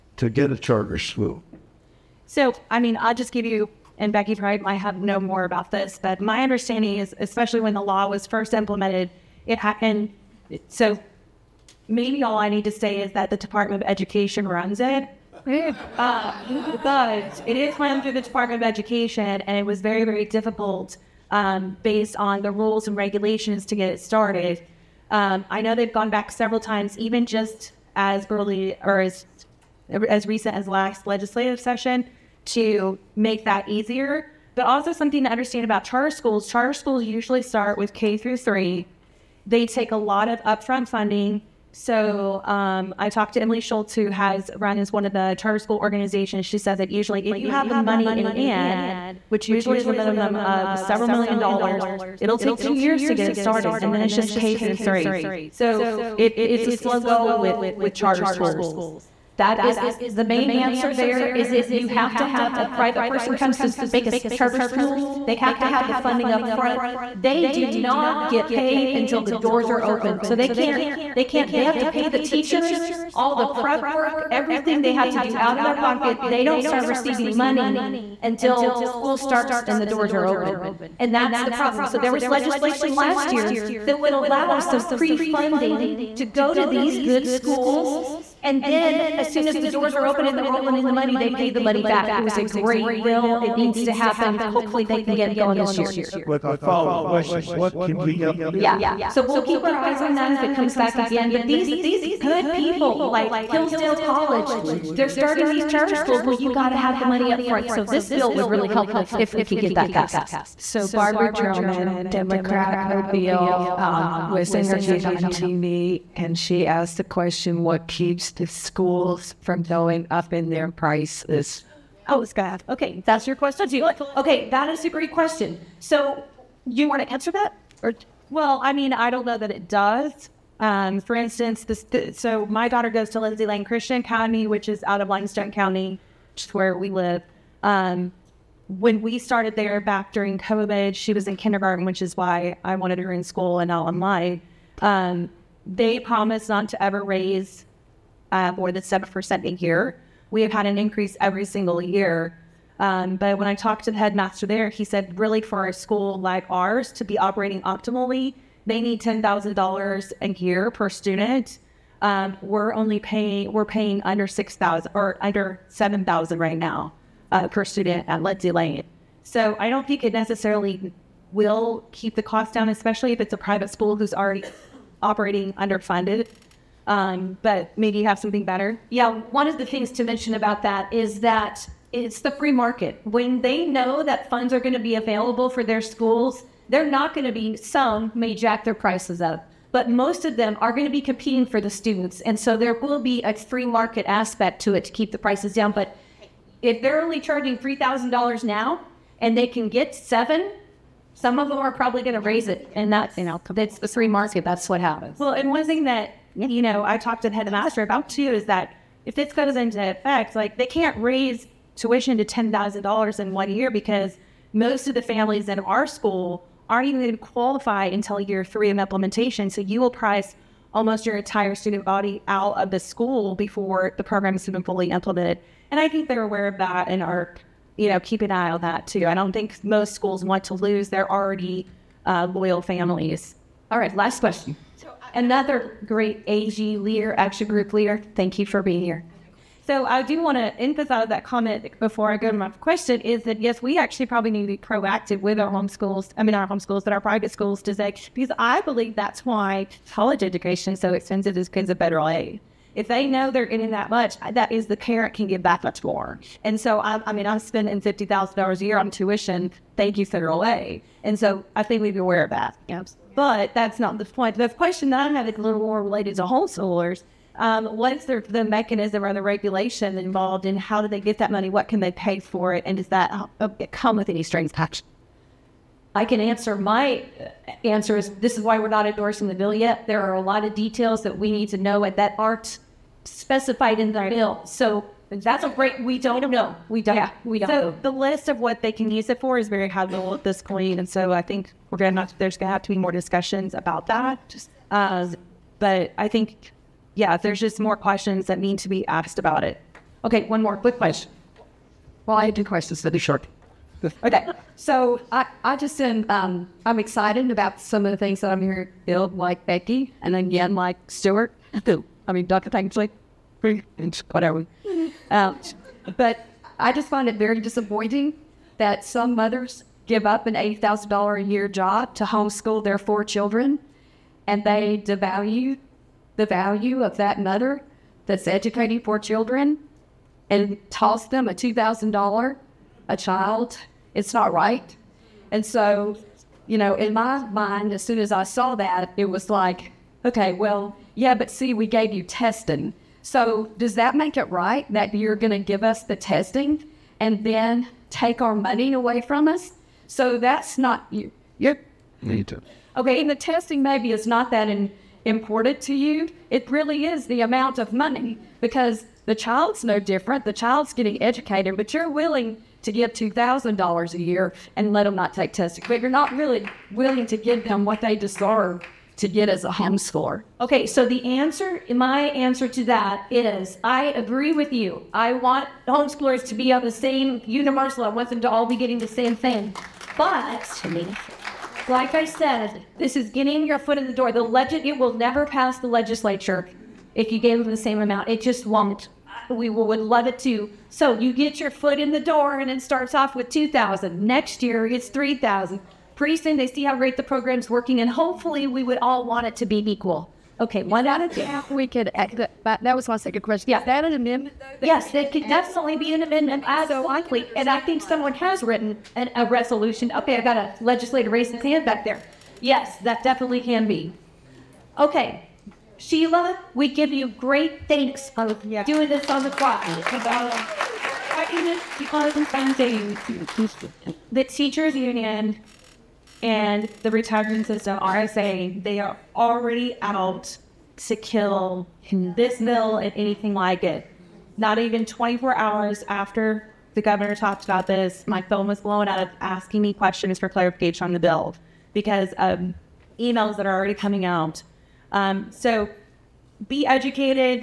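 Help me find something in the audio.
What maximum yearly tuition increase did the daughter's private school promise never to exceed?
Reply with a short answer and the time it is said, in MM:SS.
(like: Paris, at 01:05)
7%, at 02:28.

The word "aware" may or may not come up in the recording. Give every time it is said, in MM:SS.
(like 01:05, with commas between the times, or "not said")
03:46, 04:22.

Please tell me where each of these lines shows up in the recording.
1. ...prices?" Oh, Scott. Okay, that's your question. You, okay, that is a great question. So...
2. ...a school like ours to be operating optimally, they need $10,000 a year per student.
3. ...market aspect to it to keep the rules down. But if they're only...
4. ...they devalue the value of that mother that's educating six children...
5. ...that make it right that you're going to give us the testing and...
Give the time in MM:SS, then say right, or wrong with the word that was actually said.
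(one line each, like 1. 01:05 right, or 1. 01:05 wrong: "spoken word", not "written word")
1. 02:00 right
2. 02:35 right
3. 03:13 wrong: "prices", not "rules"
4. 05:24 wrong: "four", not "six"
5. 05:43 right.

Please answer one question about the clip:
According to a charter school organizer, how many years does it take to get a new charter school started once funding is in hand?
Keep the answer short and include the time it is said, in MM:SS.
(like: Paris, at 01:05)
2 years, at 00:52.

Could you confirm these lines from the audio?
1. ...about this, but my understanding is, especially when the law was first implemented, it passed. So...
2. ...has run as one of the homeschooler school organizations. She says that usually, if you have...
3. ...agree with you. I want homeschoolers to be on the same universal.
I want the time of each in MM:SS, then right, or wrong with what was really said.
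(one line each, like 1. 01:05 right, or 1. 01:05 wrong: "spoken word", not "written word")
1. 00:05 wrong: "happened", not "passed"
2. 00:44 wrong: "charter", not "homeschooler"
3. 06:13 right.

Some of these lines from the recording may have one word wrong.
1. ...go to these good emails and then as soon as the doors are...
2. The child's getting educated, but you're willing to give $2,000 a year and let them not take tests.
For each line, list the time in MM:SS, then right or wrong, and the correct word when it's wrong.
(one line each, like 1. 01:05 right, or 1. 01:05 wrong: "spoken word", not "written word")
1. 01:26 wrong: "schools", not "emails"
2. 06:00 right.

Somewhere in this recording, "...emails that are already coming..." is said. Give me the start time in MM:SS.
07:23.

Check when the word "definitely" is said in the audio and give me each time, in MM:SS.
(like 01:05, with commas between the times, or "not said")
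06:45, 06:53.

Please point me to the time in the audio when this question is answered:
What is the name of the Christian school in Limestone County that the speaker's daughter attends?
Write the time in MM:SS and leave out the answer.
02:13.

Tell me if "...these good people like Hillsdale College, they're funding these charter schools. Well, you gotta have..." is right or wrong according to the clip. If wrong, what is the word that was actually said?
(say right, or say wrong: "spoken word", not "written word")
wrong: "starting", not "funding".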